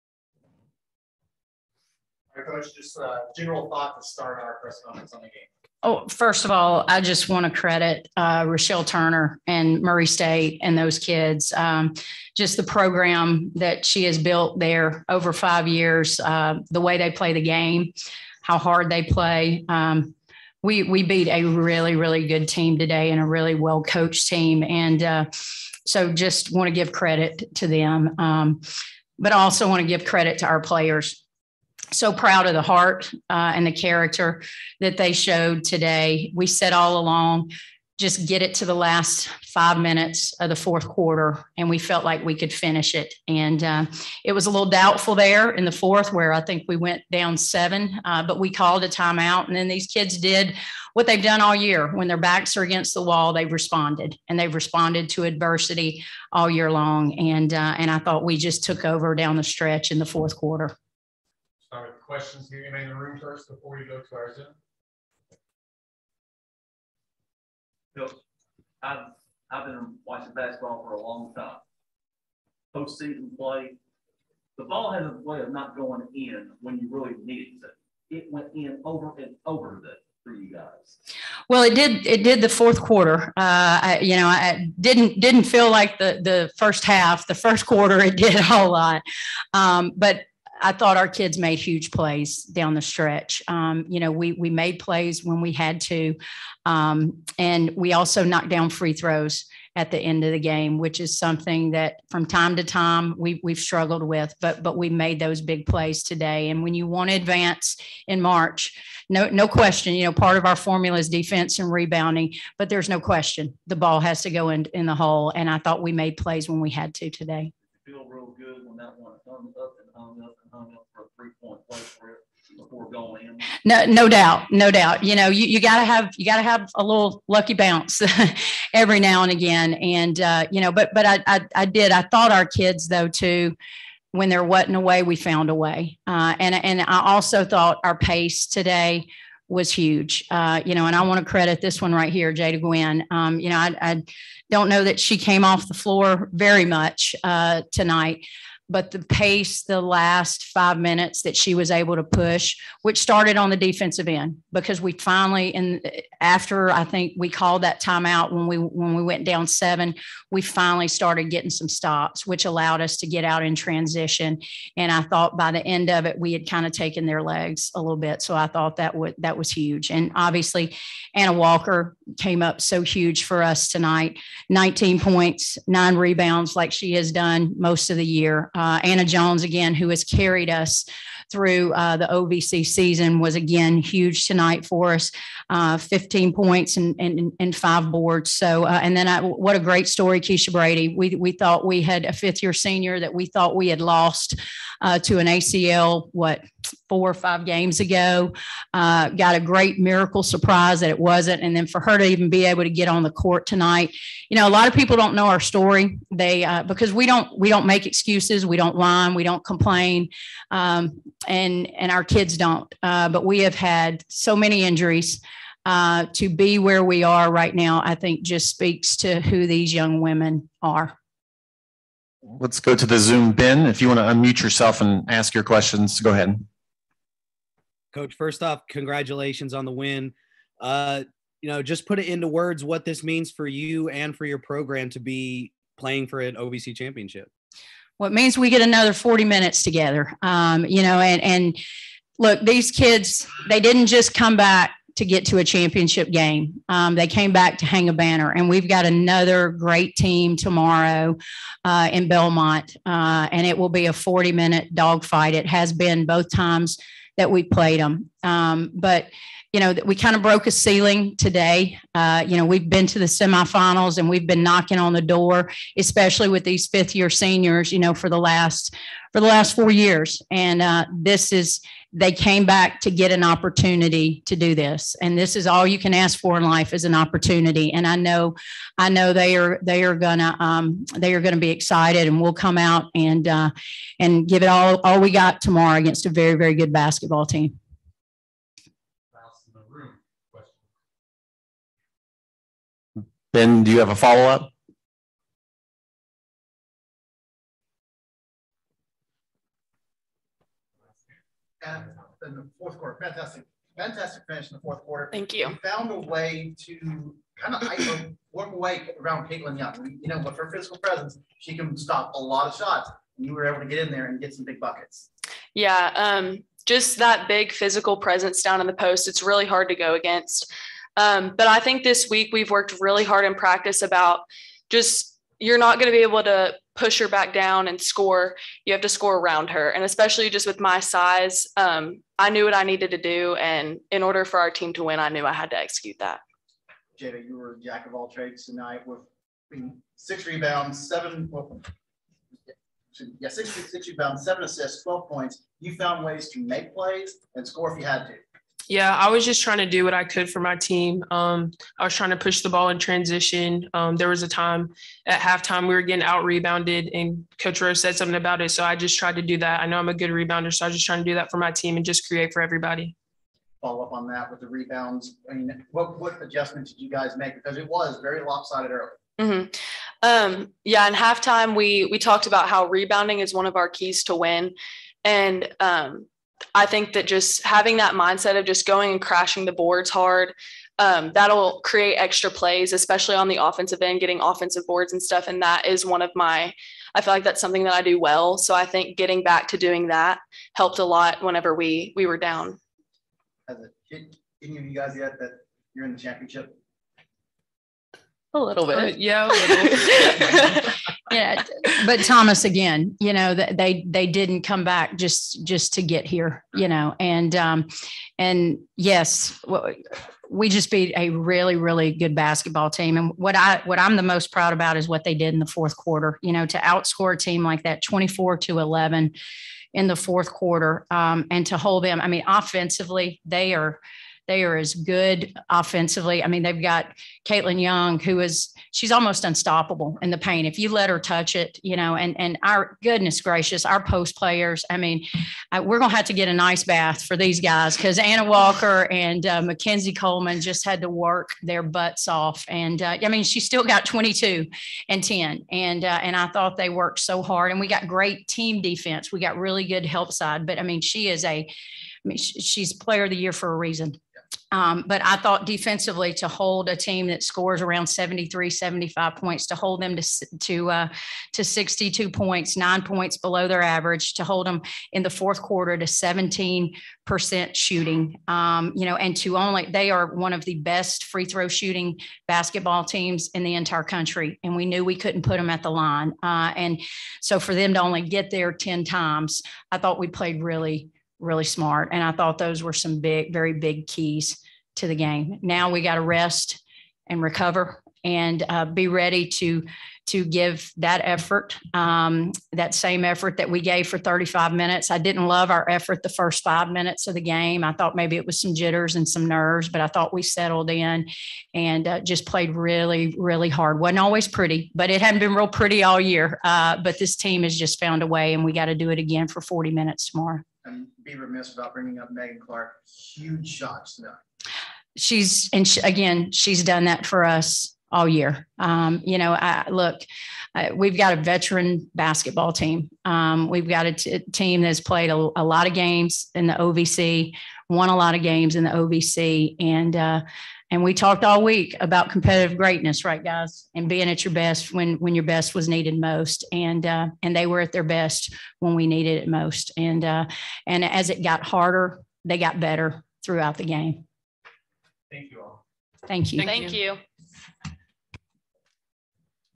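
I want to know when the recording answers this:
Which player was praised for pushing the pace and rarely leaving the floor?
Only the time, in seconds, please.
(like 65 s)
142 s.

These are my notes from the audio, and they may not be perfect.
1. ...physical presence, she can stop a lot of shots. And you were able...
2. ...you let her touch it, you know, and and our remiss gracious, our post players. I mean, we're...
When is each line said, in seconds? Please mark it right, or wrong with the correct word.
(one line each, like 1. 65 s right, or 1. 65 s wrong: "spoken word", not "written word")
1. 310 s right
2. 430 s wrong: "goodness", not "remiss".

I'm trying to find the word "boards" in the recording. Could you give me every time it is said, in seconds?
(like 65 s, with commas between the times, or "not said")
187 s, 379 s, 384 s.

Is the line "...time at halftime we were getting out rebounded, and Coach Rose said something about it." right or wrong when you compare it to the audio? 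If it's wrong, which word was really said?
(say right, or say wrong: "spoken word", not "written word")
right.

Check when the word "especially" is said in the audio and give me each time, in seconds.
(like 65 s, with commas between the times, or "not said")
265 s, 329 s, 382 s.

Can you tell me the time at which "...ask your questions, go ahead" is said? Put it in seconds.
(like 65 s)
225 s.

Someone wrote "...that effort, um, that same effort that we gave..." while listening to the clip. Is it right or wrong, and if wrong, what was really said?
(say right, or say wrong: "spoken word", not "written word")
right.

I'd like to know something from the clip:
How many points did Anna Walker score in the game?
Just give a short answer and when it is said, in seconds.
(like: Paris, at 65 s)
19, at 174 s.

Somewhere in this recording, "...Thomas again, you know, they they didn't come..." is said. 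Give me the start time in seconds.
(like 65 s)
402 s.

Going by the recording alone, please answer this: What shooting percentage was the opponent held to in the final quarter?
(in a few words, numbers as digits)
17 percent.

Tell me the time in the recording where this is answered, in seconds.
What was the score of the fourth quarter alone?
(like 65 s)
417 s.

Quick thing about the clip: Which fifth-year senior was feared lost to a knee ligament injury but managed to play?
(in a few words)
Keisha Brady.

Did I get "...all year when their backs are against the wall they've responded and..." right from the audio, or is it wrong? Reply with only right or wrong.
right.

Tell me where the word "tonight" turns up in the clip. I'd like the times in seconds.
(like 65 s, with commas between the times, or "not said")
147 s, 173 s, 184 s, 203 s, 338 s, 513 s.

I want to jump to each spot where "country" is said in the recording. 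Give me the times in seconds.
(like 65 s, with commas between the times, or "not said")
473 s.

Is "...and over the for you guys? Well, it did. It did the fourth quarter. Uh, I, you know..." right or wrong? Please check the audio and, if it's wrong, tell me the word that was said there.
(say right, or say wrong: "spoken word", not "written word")
right.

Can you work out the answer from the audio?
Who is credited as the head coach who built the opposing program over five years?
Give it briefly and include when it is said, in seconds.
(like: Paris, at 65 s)
Rechelle Turner, at 8 s.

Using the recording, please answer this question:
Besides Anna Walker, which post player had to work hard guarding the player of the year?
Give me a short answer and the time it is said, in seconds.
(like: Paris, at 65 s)
Mackenzie Coleman, at 439 s.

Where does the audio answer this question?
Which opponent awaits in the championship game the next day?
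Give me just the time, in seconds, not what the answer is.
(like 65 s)
252 s.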